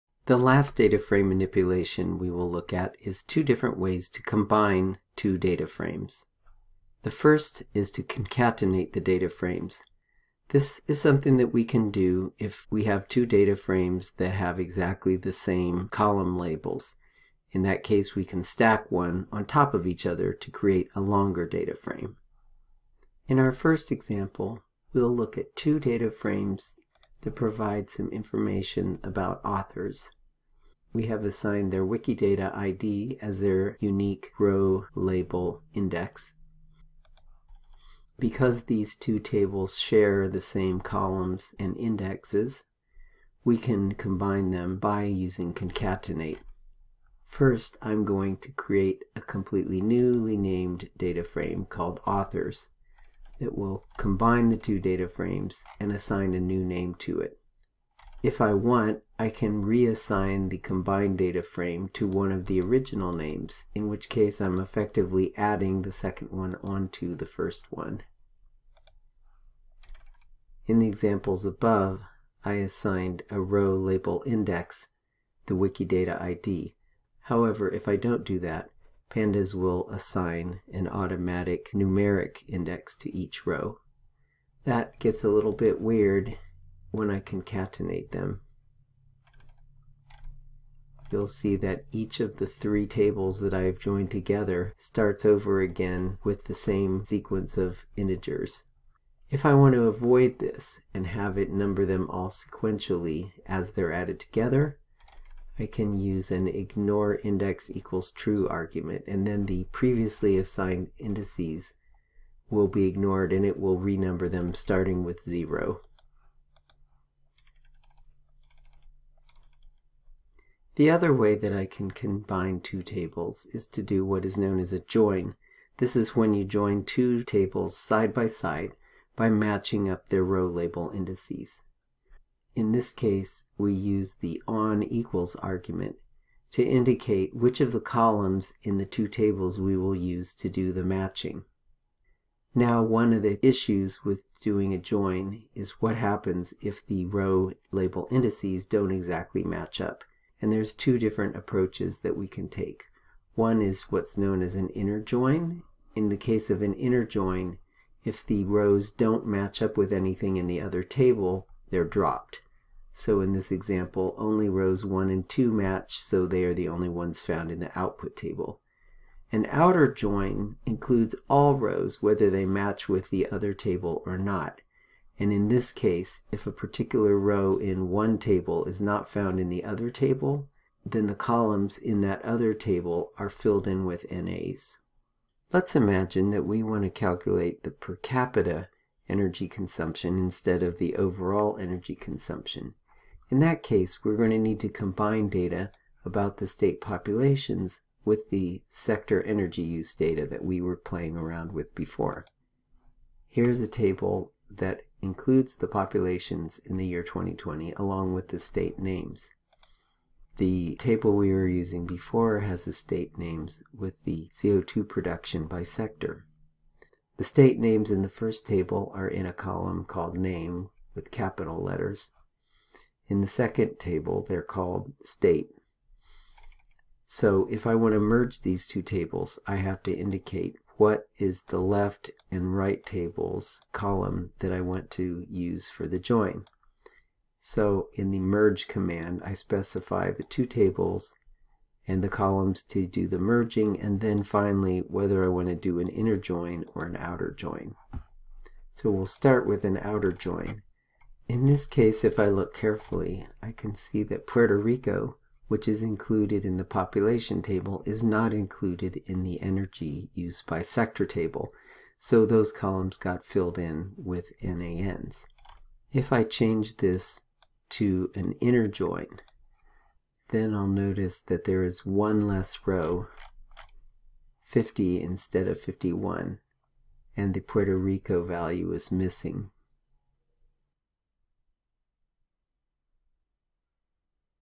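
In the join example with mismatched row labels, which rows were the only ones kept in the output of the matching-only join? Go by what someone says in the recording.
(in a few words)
rows 1 and 2.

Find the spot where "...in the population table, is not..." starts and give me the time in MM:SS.
04:16.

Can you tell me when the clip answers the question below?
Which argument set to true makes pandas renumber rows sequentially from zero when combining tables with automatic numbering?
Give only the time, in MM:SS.
01:46.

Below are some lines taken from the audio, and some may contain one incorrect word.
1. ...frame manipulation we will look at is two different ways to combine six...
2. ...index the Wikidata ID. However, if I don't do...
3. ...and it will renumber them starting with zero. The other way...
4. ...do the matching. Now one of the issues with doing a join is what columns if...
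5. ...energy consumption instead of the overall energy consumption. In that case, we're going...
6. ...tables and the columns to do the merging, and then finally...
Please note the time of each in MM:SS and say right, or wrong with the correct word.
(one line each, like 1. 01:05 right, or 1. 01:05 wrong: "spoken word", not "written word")
1. 00:00 wrong: "two", not "six"
2. 01:14 right
3. 01:53 right
4. 02:20 wrong: "happens", not "columns"
5. 03:09 right
6. 04:00 right.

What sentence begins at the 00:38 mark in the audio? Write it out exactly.
Because these two tables share the same columns and indexes, we can combine them by using concatenate.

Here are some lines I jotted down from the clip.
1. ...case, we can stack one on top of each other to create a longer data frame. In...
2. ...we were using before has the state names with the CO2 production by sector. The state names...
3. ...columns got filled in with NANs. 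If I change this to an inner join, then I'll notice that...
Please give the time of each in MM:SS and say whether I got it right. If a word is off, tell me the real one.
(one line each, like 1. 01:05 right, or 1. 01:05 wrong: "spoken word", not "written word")
1. 00:17 right
2. 03:31 right
3. 04:22 right.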